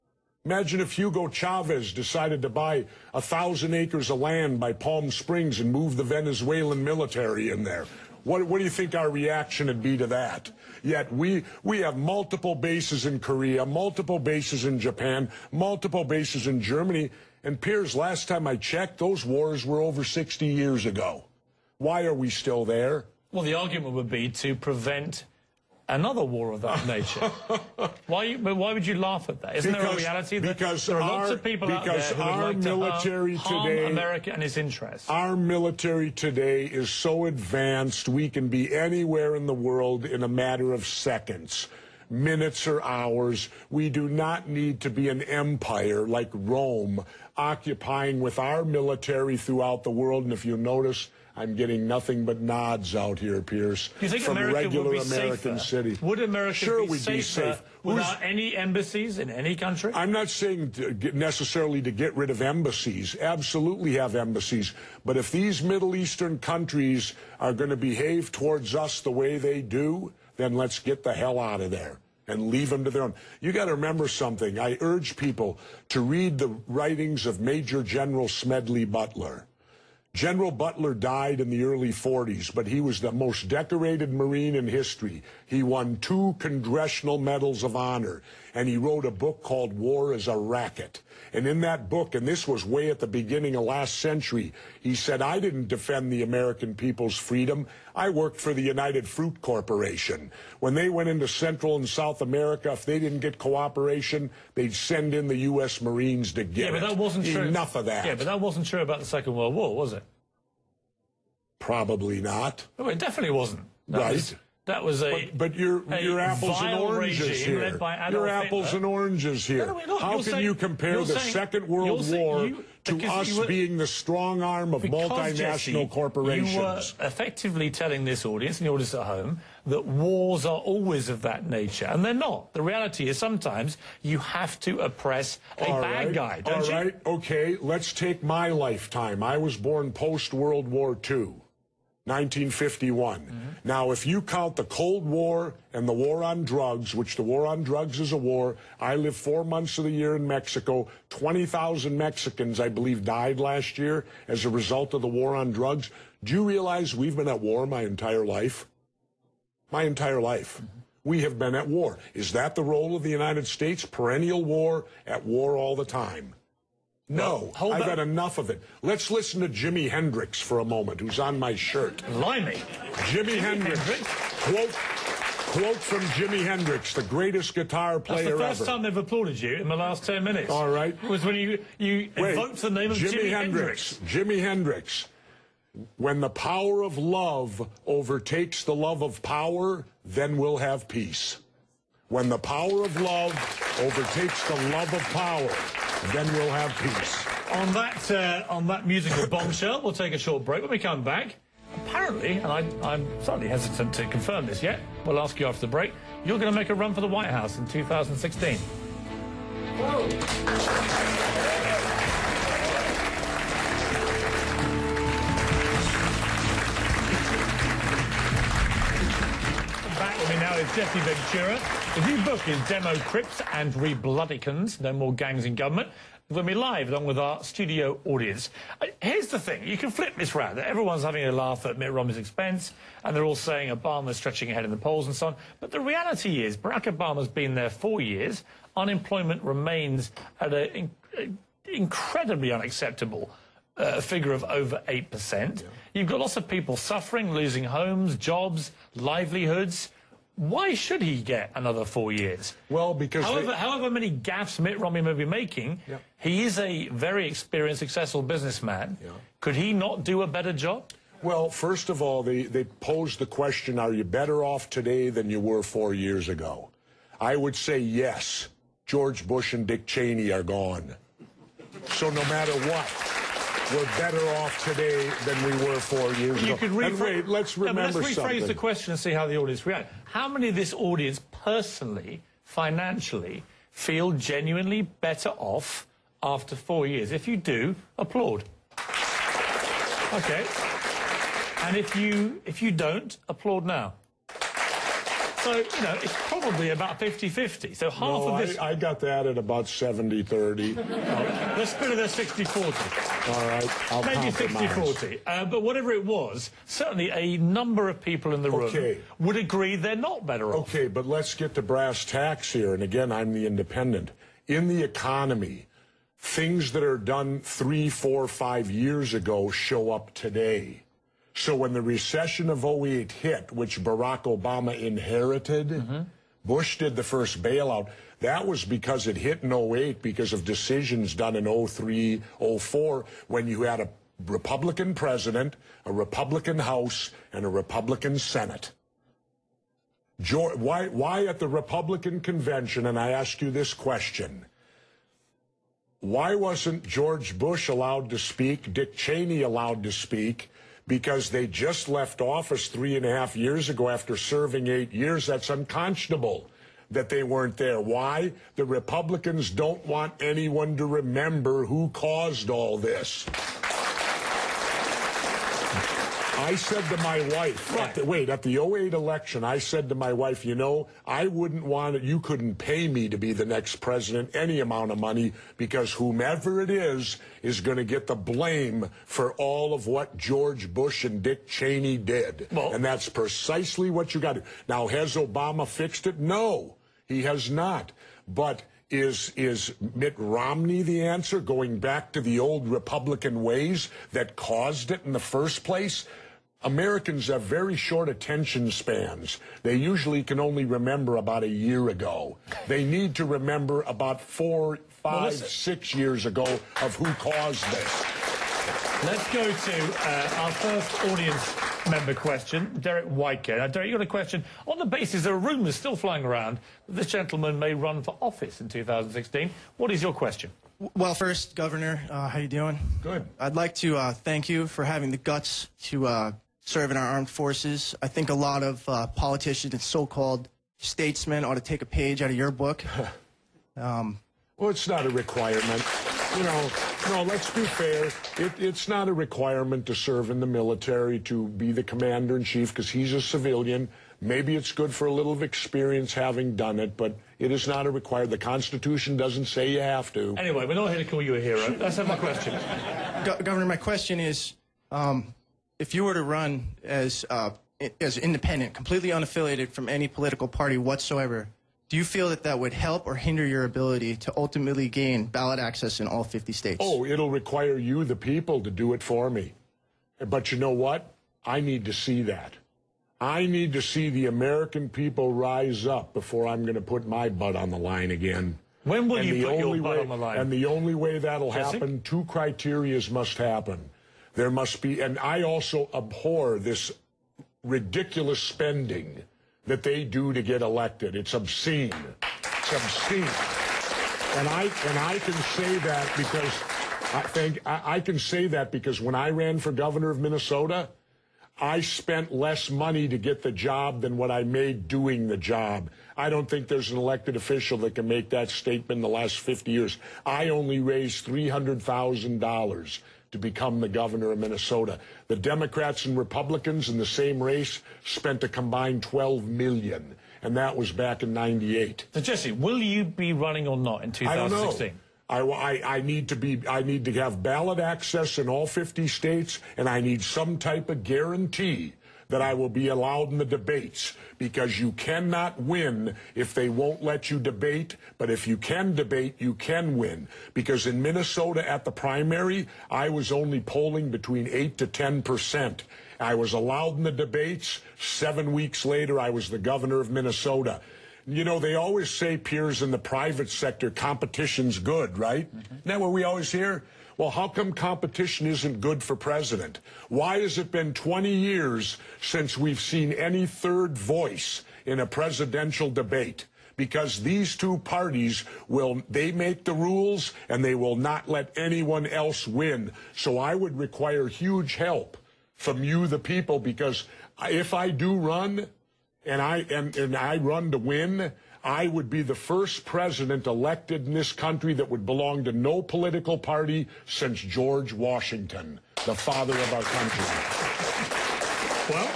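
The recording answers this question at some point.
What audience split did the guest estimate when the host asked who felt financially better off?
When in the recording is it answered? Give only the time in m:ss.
4:59.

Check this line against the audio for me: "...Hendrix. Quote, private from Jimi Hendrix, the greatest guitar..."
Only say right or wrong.
wrong.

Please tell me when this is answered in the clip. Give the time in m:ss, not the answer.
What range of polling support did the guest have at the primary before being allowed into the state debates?
9:04.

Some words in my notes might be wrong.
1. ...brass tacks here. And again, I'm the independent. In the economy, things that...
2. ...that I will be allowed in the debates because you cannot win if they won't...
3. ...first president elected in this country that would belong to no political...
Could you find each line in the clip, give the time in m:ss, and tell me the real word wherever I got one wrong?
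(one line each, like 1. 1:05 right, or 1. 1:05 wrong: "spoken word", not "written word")
1. 5:11 right
2. 8:52 right
3. 9:42 right.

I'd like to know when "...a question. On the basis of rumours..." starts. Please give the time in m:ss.
6:54.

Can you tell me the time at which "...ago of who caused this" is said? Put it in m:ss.
6:46.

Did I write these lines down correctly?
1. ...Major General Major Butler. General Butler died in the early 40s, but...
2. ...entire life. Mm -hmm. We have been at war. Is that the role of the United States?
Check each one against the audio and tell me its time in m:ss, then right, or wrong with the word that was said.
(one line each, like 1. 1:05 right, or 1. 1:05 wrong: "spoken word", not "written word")
1. 1:17 wrong: "Smedley", not "Major"
2. 2:39 right.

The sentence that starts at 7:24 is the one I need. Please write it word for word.
Maybe it's good for a little experience having done it, but it is not a required.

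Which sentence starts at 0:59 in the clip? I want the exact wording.
I'm not saying to get, necessarily to get rid of embassies.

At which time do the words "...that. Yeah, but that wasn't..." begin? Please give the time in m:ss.
1:47.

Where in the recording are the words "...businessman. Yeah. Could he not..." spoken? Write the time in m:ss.
4:18.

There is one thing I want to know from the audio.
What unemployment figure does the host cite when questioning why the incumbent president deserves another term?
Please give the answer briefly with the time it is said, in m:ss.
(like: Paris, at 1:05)
over 8%, at 4:04.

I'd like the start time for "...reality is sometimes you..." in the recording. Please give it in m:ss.
2:12.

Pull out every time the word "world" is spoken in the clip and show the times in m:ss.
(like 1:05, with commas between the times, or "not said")
0:39, 0:49, 1:49, 2:01, 2:20.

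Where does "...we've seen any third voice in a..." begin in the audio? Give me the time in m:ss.
9:22.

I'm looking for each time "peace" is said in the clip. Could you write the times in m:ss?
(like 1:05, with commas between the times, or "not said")
3:10, 3:16.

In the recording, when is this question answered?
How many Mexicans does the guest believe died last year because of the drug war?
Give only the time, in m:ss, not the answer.
2:31.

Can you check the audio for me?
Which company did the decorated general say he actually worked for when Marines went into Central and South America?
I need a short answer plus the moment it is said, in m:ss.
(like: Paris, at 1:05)
United Fruit Corporation, at 1:38.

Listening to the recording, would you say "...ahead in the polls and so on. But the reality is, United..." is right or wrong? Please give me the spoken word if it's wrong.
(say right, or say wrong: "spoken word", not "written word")
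wrong: "Barack", not "United".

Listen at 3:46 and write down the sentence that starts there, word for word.
When we live, along with our studio audience.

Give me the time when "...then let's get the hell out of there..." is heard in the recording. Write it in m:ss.
1:10.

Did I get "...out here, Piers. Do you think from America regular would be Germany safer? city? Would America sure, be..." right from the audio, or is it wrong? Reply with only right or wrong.
wrong.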